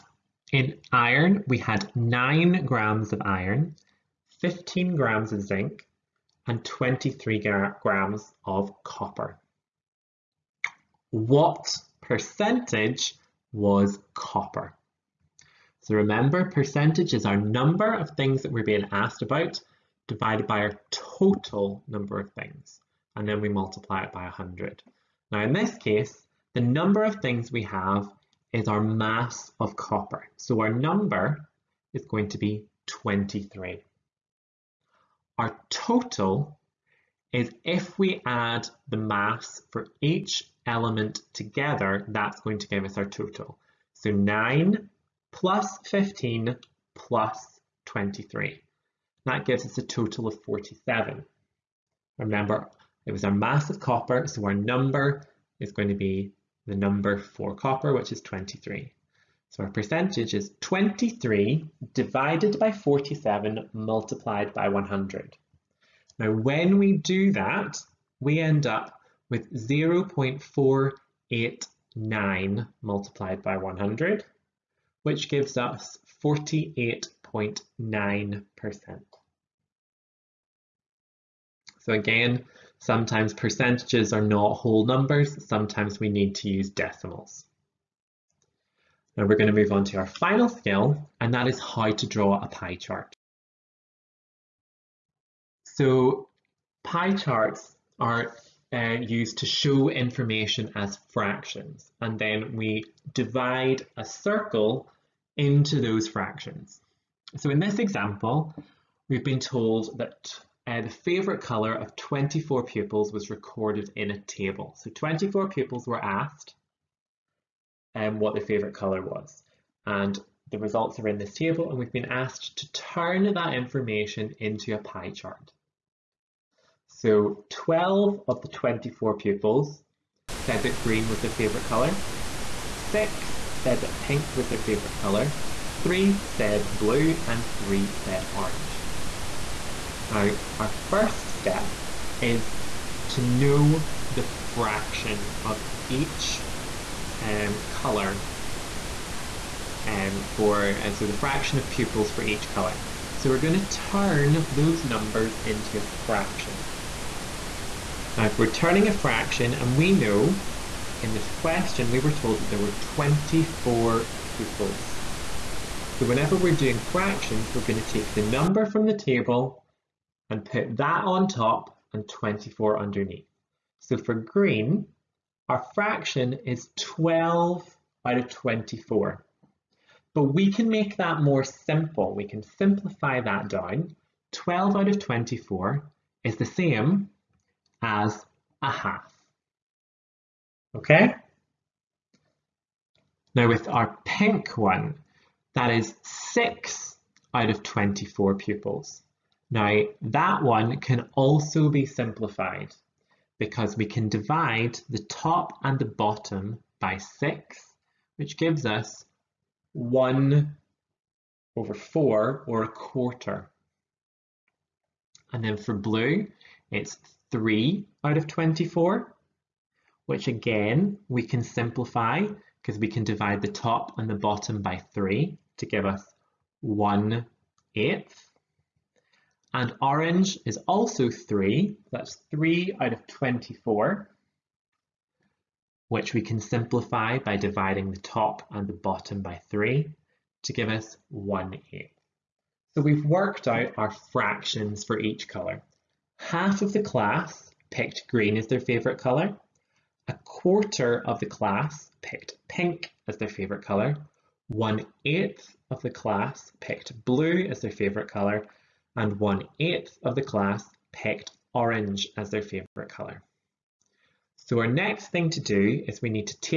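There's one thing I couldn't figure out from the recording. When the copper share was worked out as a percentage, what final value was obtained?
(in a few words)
48.9%.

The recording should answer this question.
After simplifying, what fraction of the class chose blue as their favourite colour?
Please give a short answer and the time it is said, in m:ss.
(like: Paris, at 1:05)
1/8, at 3:46.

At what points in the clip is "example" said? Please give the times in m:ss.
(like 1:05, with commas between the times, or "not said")
1:47.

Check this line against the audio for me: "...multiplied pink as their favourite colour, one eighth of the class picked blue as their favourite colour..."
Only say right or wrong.
wrong.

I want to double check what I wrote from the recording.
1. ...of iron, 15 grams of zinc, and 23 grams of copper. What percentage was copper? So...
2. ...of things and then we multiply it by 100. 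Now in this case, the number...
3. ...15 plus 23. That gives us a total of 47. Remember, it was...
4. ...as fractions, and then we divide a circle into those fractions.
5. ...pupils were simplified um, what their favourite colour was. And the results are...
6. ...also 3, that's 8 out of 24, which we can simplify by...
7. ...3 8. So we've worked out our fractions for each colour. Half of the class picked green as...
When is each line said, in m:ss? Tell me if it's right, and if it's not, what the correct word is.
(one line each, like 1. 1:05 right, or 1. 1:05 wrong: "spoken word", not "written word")
1. 0:03 right
2. 0:22 right
3. 0:45 right
4. 1:40 right
5. 1:55 wrong: "asked", not "simplified"
6. 3:50 wrong: "3", not "8"
7. 4:01 wrong: "1", not "3".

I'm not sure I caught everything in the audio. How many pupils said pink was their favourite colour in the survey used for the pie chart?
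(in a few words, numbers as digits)
6.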